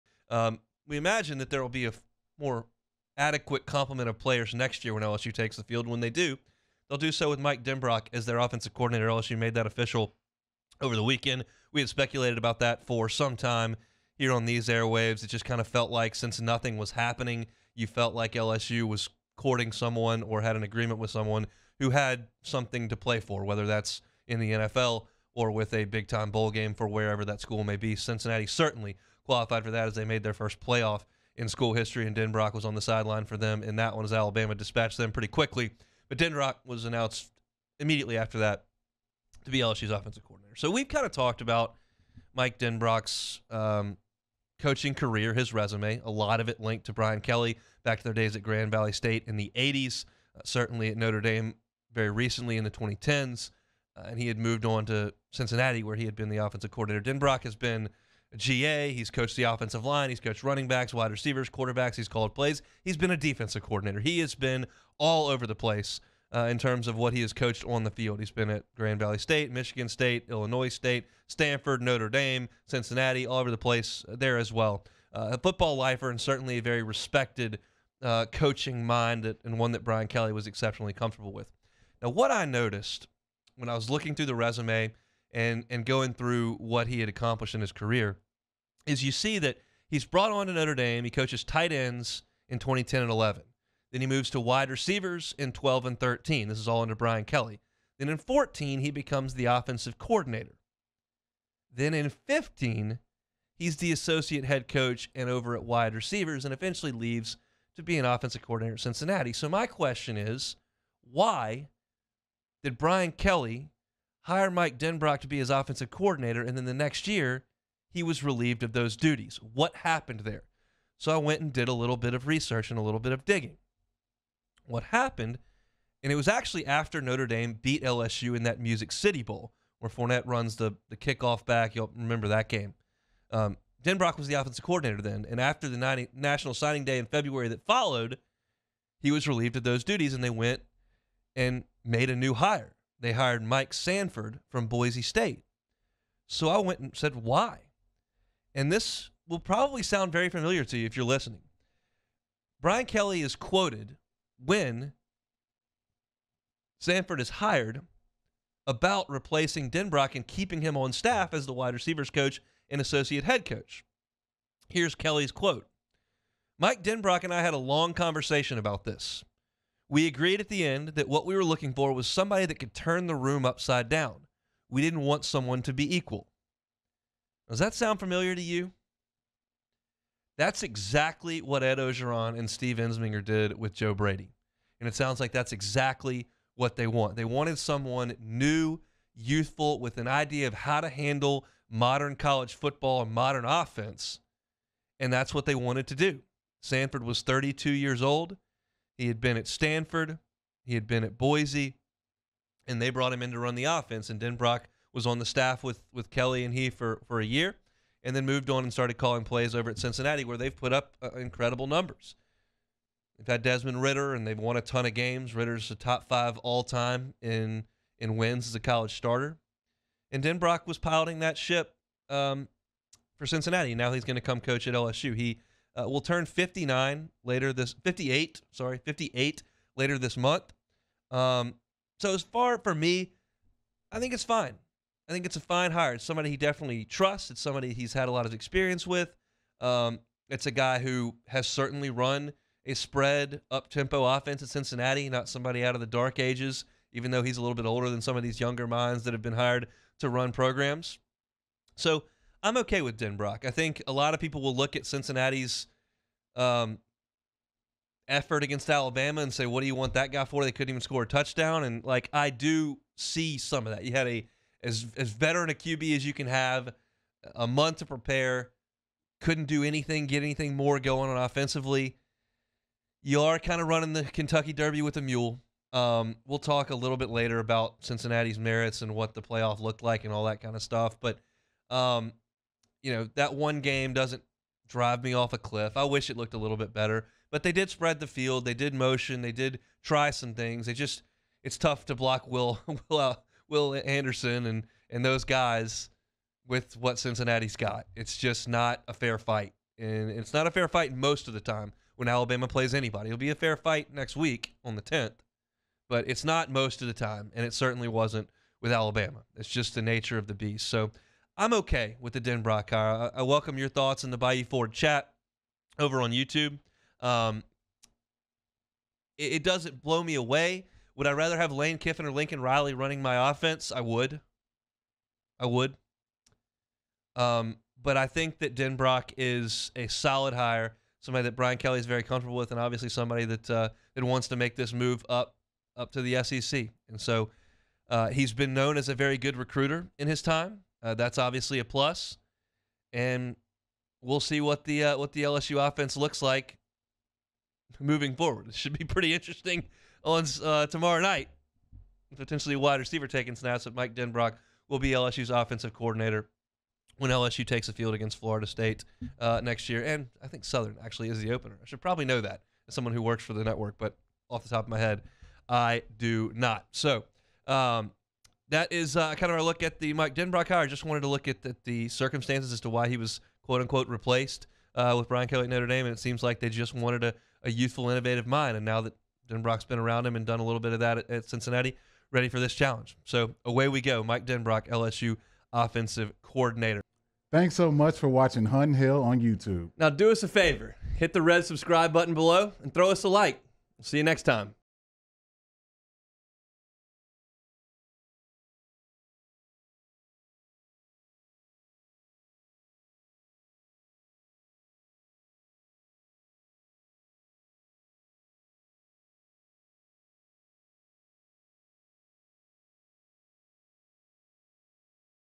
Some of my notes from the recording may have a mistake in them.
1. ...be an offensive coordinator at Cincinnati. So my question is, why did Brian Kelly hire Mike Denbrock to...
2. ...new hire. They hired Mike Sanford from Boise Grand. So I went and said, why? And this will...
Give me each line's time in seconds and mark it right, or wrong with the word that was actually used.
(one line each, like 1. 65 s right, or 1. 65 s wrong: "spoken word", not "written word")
1. 107 s right
2. 142 s wrong: "State", not "Grand".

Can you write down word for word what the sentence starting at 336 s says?
And so uh, he's been known as a very good recruiter in his time.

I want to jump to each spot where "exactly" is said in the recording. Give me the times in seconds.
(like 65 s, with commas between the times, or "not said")
180 s, 185 s.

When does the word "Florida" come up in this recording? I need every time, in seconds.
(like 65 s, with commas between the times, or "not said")
358 s.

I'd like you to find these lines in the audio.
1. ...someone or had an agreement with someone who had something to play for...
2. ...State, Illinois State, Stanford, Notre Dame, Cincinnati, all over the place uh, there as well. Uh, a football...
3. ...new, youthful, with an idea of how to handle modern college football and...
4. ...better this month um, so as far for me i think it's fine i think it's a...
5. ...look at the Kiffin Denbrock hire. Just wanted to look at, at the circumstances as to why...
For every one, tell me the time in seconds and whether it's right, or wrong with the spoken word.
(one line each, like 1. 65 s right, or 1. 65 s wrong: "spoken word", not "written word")
1. 19 s right
2. 69 s right
3. 188 s right
4. 229 s wrong: "later", not "better"
5. 369 s wrong: "Mike", not "Kiffin".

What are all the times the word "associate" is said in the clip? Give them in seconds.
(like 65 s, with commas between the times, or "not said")
103 s, 162 s.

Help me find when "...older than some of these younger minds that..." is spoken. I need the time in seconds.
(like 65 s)
247 s.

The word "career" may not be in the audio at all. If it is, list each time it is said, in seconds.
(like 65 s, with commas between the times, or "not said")
44 s, 87 s.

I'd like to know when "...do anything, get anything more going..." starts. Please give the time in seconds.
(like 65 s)
269 s.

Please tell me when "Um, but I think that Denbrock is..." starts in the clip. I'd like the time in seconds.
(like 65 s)
327 s.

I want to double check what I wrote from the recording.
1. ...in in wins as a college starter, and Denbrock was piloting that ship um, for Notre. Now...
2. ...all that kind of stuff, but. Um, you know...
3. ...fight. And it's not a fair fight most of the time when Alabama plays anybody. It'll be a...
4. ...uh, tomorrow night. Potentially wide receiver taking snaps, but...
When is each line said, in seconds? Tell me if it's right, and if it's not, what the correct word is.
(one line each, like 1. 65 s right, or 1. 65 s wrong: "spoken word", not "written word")
1. 217 s wrong: "Cincinnati", not "Notre"
2. 280 s right
3. 299 s right
4. 350 s right.